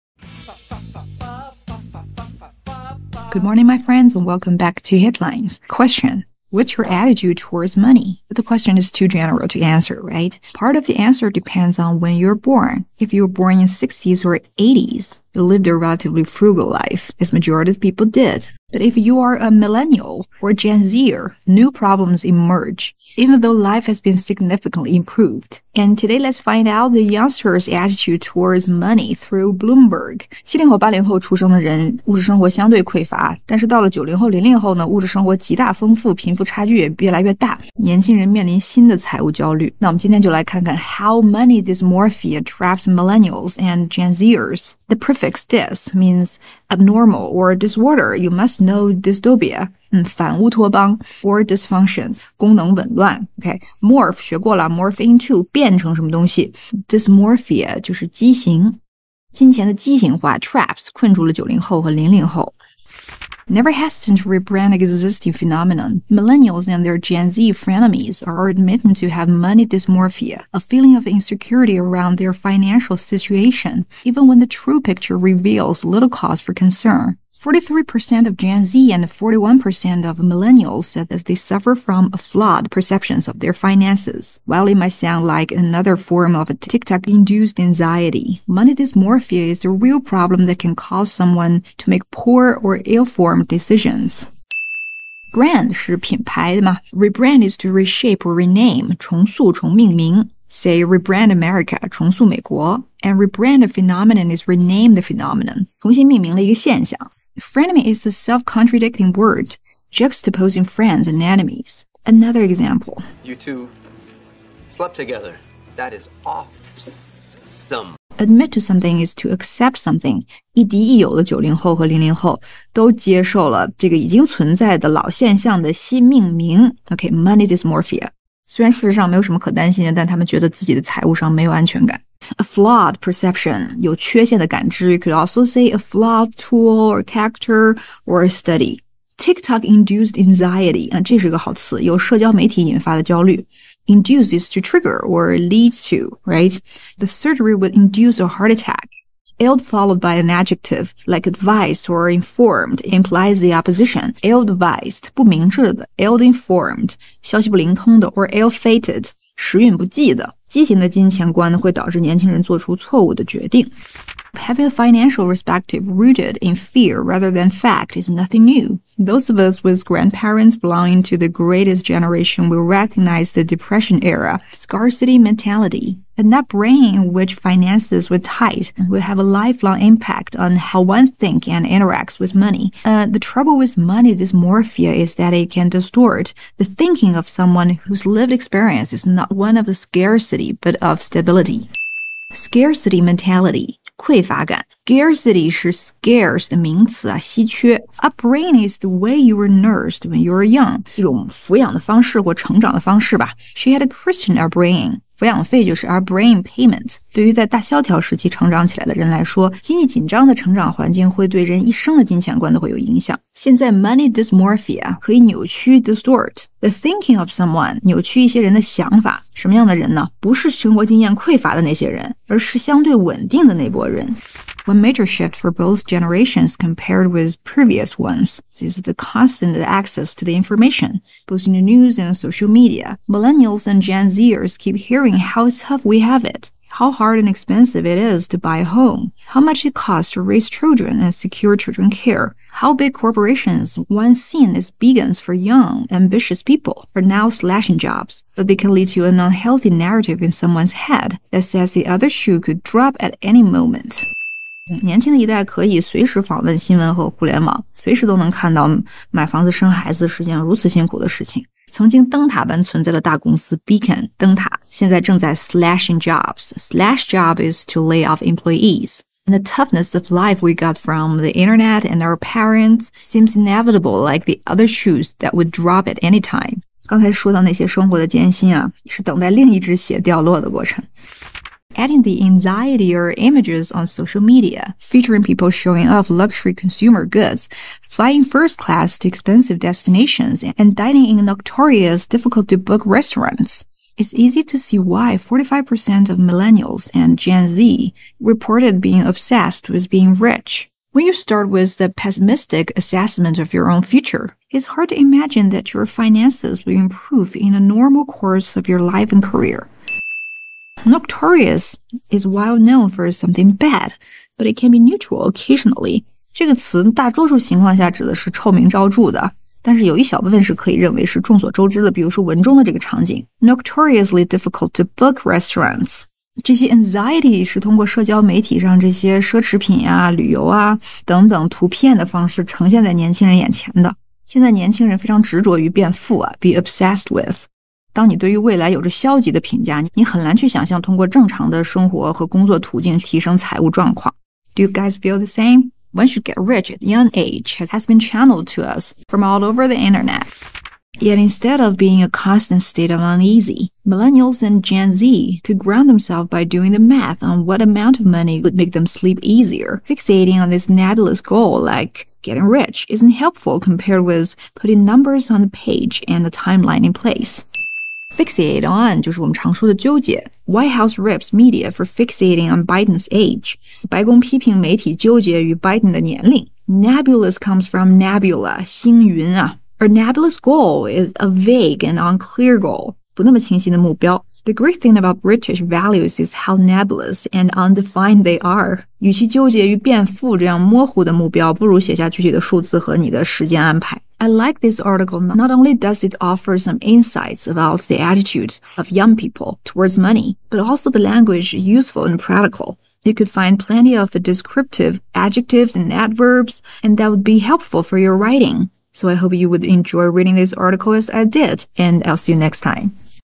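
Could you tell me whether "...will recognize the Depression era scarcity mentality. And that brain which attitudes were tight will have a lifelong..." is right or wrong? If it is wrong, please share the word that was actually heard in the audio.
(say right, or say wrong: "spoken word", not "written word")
wrong: "finances", not "attitudes".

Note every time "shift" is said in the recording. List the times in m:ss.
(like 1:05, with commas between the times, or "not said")
3:45.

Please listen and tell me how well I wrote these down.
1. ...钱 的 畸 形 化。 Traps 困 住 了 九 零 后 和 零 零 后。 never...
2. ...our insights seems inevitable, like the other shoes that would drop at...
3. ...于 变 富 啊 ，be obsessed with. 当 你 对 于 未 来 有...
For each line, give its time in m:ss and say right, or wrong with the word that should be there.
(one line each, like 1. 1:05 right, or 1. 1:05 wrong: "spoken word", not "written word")
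1. 0:59 right
2. 4:32 wrong: "parents", not "insights"
3. 5:35 right.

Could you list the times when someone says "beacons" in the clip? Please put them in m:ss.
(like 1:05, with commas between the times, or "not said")
4:04, 4:23.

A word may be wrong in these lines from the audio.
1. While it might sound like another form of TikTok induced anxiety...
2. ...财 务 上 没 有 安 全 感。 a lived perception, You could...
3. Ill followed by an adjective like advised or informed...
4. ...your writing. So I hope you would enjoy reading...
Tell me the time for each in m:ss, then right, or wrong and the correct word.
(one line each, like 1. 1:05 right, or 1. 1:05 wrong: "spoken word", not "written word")
1. 1:24 right
2. 2:10 wrong: "flawed", not "lived"
3. 2:29 right
4. 6:47 right.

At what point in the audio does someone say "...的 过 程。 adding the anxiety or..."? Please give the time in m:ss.
4:40.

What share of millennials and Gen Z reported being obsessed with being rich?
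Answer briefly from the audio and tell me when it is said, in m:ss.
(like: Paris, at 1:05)
45%, at 4:55.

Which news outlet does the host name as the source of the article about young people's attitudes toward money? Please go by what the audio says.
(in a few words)
Bloomberg.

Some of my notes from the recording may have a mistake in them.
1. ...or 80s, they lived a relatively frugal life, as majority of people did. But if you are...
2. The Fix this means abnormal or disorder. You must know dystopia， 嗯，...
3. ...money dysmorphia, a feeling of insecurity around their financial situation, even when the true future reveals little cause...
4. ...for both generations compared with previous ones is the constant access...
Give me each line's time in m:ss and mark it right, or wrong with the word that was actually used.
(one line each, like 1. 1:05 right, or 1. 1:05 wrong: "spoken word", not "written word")
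1. 0:14 right
2. 0:44 right
3. 1:09 wrong: "picture", not "future"
4. 3:45 right.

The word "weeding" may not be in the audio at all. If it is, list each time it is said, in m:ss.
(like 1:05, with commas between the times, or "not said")
not said.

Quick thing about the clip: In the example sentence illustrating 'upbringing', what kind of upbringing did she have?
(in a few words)
Christian.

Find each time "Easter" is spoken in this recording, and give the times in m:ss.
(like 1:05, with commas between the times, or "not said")
not said.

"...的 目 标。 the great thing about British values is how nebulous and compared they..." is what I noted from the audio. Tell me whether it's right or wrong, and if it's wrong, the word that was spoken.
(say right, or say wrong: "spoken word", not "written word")
wrong: "undefined", not "compared".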